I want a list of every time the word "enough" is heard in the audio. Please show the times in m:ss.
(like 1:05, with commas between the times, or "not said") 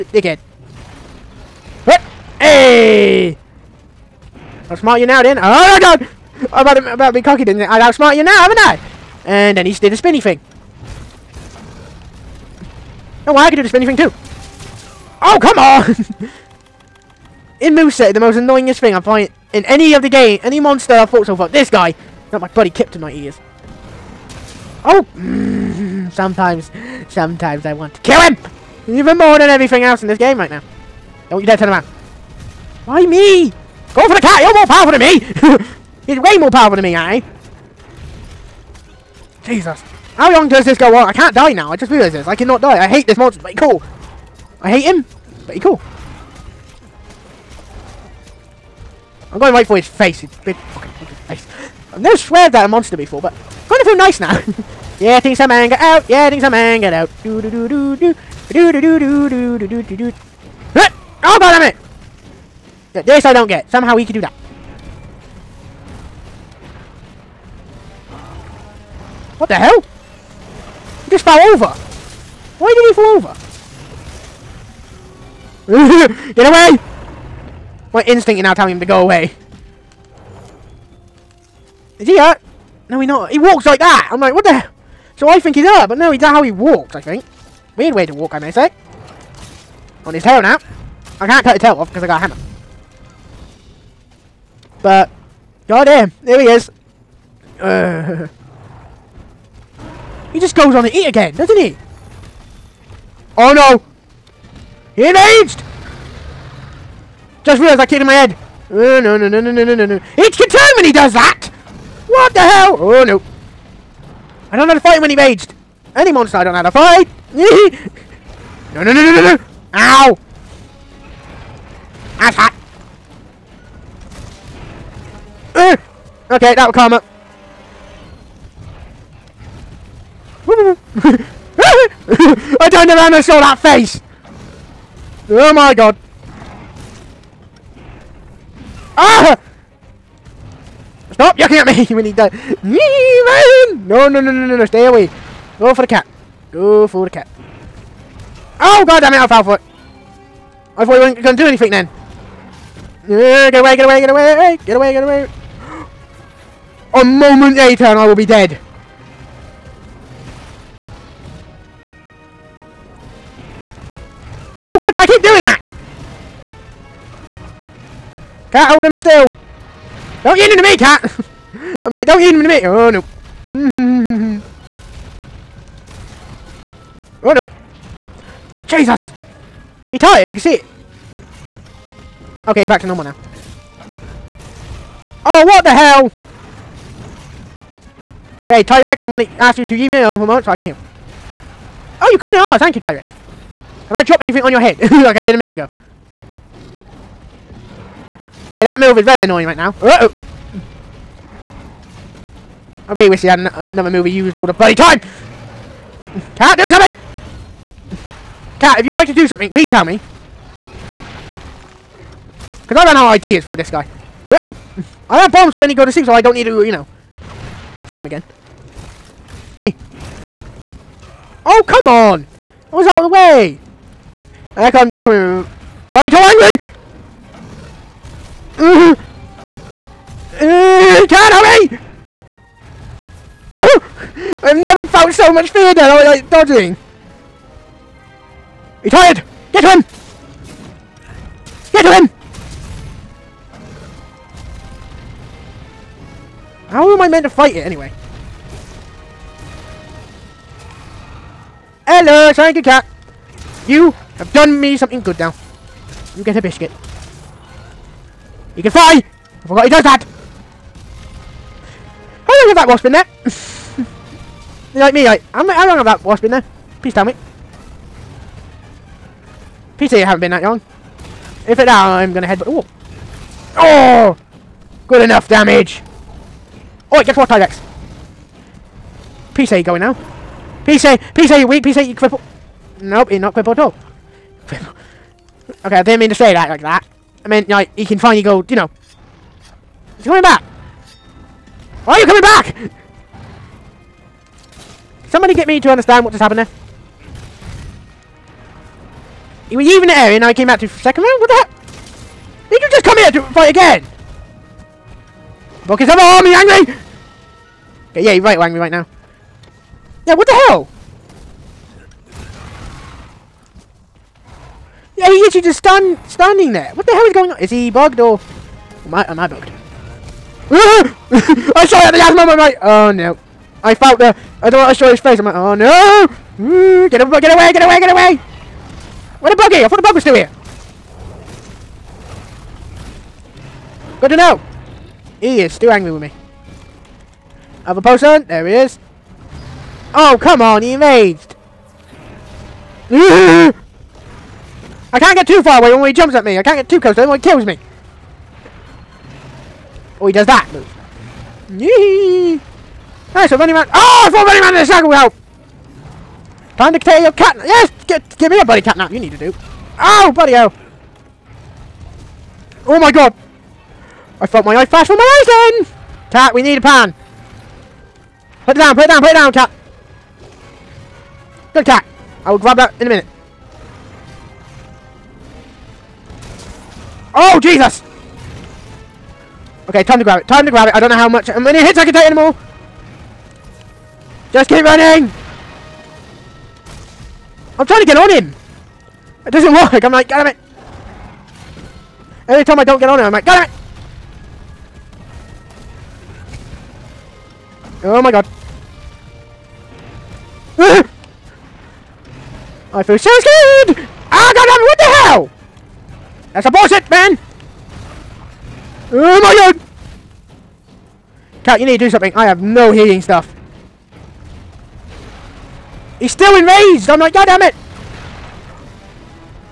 4:35.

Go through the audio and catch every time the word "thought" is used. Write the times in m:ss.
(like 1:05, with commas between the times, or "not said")
2:30, 5:29, 5:54.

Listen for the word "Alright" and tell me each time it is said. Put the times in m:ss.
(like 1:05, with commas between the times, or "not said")
5:53.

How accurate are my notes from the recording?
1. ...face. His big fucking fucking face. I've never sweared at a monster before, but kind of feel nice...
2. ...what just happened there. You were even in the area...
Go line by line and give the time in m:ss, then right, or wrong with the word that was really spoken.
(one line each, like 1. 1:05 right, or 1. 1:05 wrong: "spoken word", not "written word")
1. 0:49 right
2. 4:56 right.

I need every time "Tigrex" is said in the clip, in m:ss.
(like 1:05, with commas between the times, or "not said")
3:08, 3:12, 4:37.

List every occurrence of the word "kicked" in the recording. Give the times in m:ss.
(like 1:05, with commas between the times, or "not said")
not said.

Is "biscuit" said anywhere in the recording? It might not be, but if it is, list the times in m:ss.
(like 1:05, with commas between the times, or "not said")
4:16.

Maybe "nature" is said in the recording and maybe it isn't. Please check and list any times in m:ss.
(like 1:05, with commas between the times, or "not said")
not said.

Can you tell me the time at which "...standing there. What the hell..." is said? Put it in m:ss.
5:16.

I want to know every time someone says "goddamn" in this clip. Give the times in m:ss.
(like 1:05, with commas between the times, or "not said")
1:35.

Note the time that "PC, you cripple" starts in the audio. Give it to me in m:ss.
4:41.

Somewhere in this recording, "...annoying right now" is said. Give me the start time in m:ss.
3:19.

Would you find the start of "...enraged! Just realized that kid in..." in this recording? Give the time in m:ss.
1:45.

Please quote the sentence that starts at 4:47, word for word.
I meant, like, he can finally go, you know.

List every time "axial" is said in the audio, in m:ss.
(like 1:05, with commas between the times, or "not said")
not said.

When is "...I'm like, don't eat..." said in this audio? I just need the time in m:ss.
2:51.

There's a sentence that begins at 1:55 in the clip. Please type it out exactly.
Any monster I don't know how to fight!